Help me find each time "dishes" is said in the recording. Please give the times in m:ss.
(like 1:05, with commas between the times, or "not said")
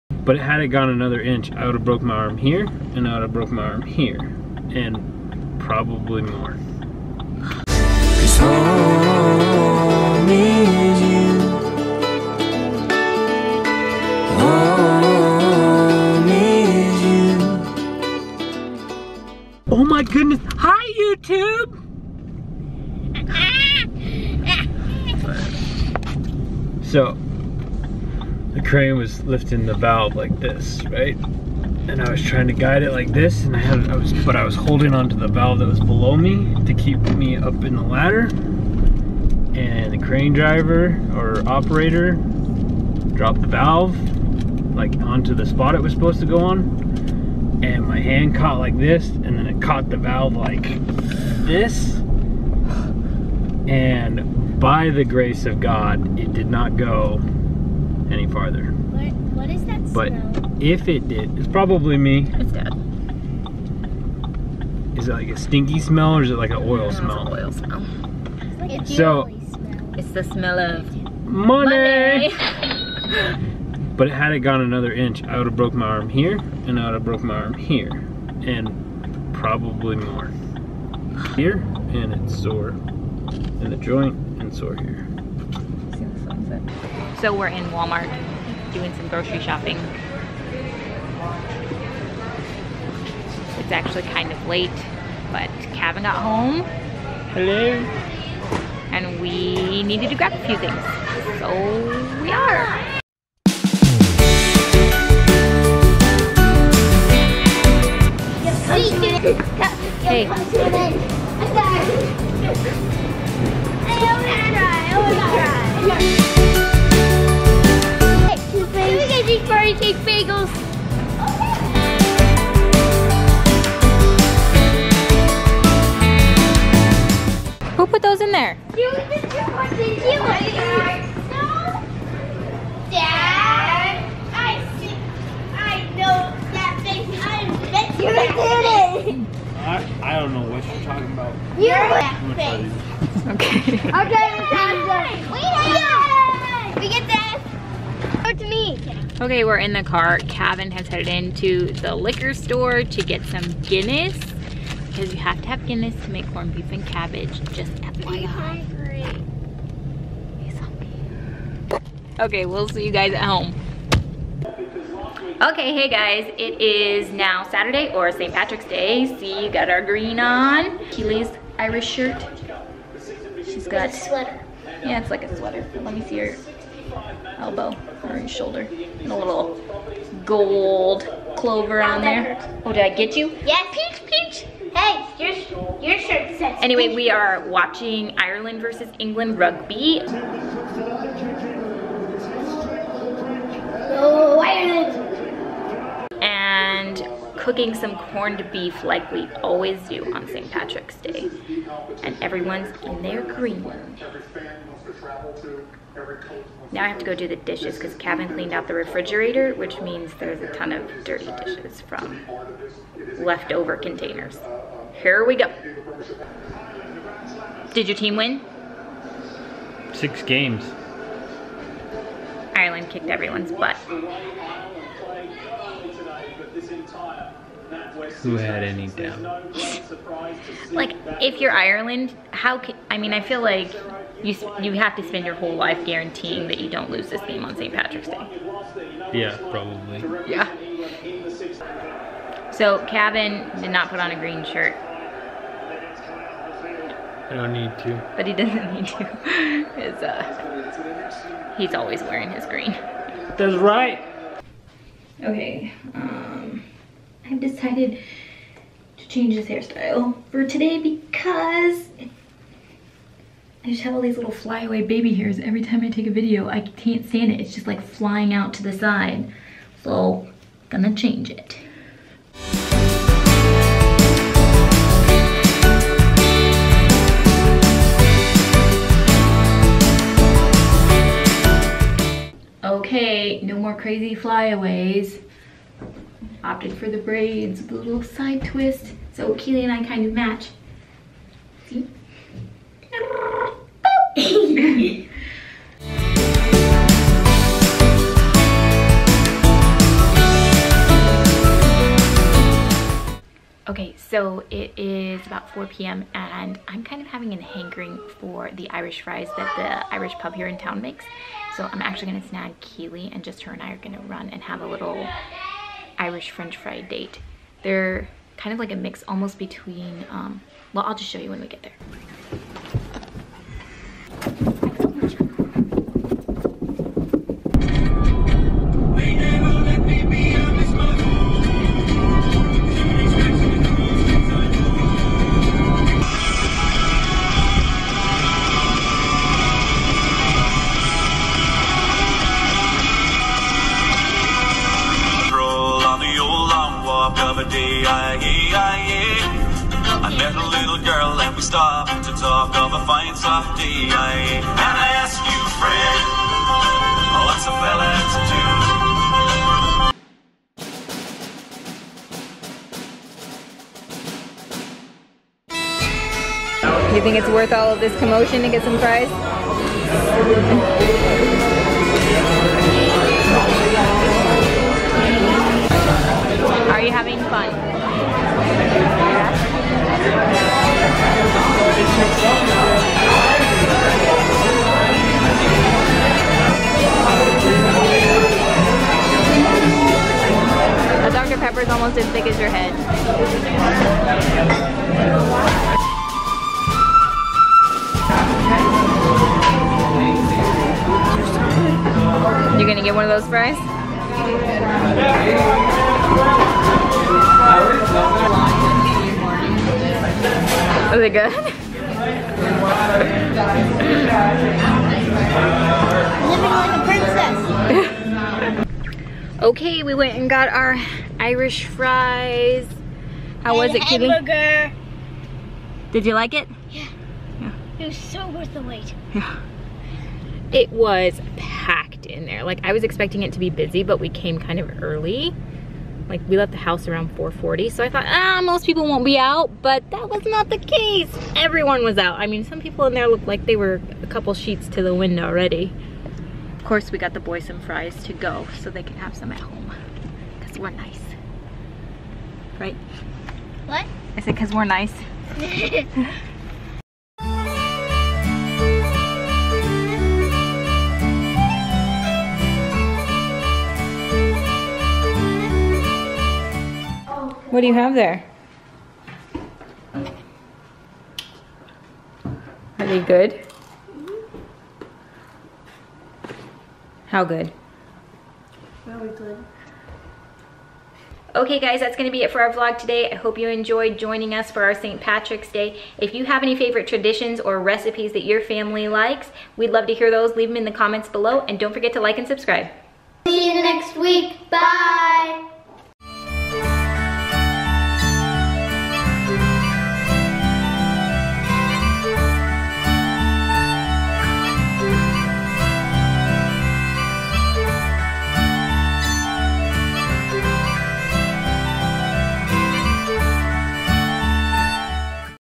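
3:27, 3:31.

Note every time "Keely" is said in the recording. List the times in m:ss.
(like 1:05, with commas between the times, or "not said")
2:50, 4:49, 5:12.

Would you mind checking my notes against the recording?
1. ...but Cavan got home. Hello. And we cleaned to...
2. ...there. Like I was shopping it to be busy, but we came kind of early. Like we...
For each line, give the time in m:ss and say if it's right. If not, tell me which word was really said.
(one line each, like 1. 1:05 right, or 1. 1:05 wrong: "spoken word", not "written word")
1. 1:35 wrong: "needed", not "cleaned"
2. 7:12 wrong: "expecting", not "shopping".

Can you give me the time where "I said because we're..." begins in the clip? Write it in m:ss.
7:34.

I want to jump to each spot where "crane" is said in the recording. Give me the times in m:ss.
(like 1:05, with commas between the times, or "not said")
0:28, 0:39.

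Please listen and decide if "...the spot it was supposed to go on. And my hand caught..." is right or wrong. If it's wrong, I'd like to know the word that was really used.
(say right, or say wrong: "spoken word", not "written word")
right.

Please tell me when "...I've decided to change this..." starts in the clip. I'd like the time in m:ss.
4:17.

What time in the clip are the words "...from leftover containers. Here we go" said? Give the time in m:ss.
3:31.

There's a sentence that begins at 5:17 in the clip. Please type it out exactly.
They're kind of like a mix almost between, um, well, I'll just show you when we get there.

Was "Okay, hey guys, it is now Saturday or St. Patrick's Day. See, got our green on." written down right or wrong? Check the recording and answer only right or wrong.
right.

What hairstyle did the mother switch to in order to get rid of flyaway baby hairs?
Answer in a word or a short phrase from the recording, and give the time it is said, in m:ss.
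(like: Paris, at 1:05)
braids, at 4:46.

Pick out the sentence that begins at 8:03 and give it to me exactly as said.
I hope you enjoyed joining us for our St.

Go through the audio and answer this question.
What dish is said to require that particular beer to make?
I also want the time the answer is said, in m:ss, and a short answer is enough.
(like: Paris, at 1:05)
corned beef and cabbage, at 2:36.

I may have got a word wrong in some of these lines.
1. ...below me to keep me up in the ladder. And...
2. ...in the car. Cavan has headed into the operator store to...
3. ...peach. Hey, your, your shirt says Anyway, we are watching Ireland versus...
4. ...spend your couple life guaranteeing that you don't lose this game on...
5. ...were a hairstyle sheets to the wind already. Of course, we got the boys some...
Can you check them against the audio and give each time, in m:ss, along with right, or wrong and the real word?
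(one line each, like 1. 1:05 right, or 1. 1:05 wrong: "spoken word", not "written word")
1. 0:35 right
2. 2:29 wrong: "liquor", not "operator"
3. 3:04 right
4. 3:55 wrong: "whole", not "couple"
5. 7:23 wrong: "couple", not "hairstyle".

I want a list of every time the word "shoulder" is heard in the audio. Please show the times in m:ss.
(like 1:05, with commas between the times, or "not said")
2:58.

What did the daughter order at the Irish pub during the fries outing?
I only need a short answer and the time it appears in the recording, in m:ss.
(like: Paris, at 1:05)
Hamburger, at 7:04.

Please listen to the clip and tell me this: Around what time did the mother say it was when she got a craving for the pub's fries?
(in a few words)
4 p.m.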